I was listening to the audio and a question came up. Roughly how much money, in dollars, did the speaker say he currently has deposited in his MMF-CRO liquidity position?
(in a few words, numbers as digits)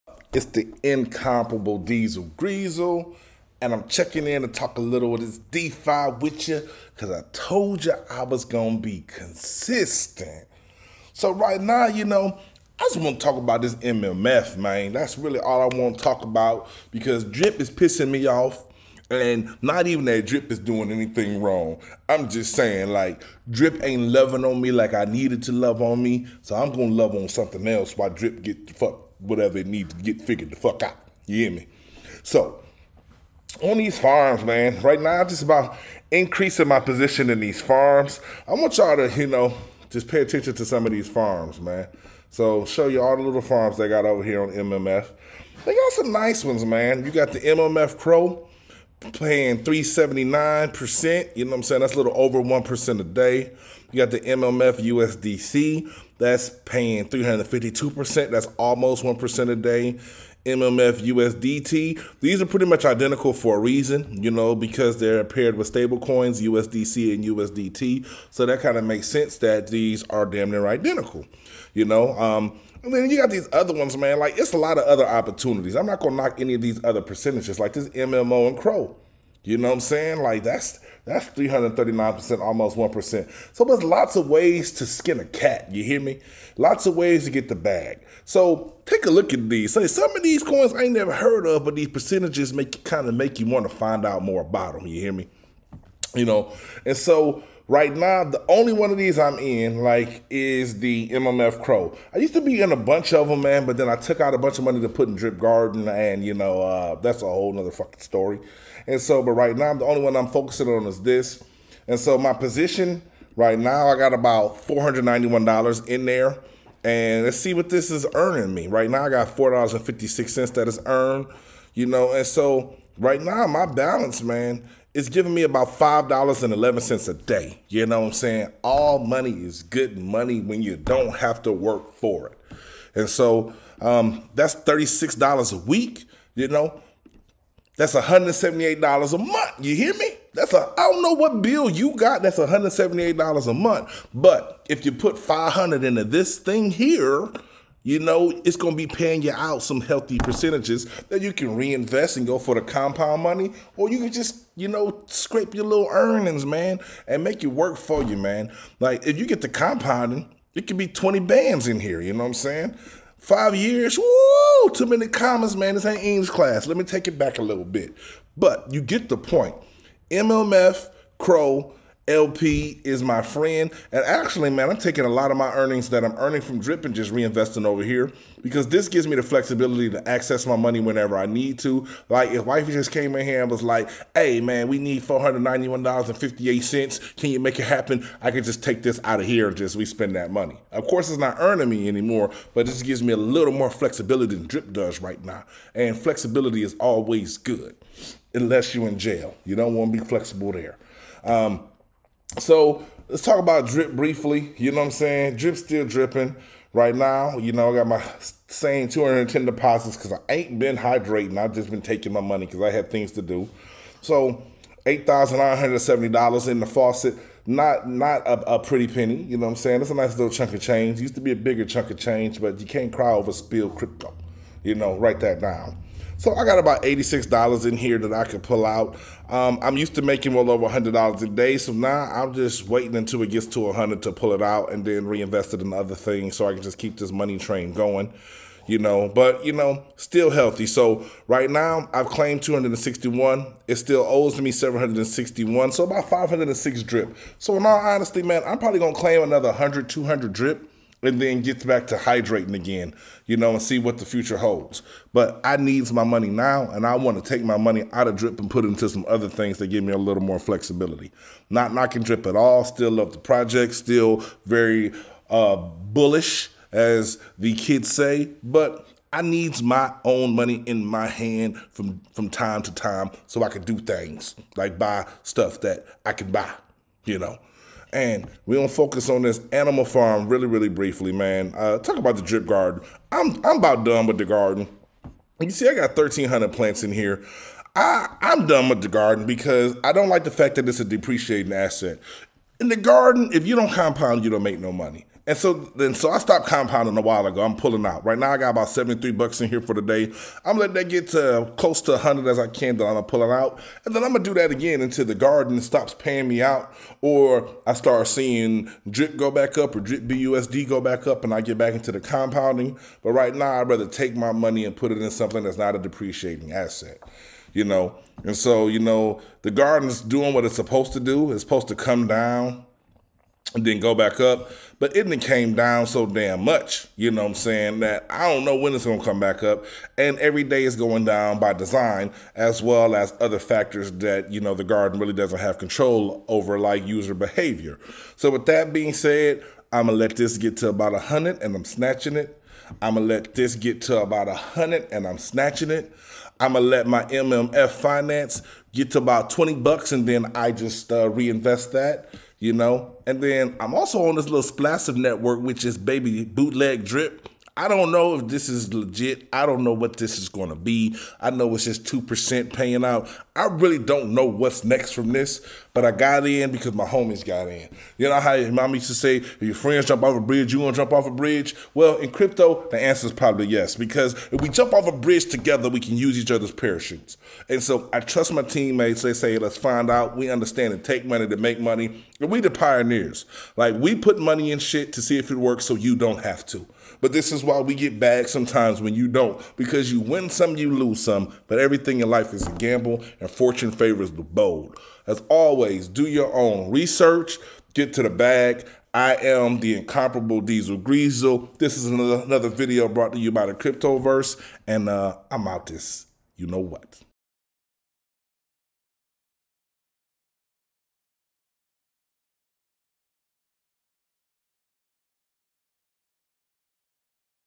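$491.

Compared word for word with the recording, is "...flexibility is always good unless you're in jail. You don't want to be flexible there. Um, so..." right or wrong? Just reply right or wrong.
right.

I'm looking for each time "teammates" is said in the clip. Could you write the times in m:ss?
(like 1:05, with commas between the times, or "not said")
6:18.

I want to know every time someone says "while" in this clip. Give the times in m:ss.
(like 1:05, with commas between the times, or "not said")
0:27, 4:57.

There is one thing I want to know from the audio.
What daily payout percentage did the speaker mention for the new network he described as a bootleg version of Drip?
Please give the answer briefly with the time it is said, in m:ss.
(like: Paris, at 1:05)
2%, at 6:01.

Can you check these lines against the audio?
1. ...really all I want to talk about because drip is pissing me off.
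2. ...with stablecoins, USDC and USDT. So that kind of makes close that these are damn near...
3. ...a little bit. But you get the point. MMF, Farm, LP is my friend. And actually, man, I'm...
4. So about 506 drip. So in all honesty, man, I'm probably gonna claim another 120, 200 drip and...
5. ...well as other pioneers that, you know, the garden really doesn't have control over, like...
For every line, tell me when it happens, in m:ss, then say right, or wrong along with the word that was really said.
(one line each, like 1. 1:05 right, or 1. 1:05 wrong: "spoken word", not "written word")
1. 0:15 right
2. 1:05 wrong: "sense", not "close"
3. 2:47 wrong: "CRO", not "Farm"
4. 4:05 wrong: "100", not "120"
5. 5:32 wrong: "factors", not "pioneers".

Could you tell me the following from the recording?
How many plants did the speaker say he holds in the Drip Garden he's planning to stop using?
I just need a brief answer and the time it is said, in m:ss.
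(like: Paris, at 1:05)
1,300, at 4:45.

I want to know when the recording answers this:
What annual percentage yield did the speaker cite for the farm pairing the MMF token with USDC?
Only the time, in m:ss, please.
0:57.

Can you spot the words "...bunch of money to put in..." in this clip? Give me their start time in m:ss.
1:44.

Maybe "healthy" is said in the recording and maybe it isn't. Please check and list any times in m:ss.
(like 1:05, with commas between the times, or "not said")
2:29, 4:00.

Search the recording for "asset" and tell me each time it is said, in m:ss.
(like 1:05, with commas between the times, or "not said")
4:51, 5:16.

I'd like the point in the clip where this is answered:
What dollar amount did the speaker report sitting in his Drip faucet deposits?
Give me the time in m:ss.
3:34.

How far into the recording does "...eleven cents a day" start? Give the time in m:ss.
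2:06.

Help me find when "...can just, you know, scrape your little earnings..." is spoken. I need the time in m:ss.
2:33.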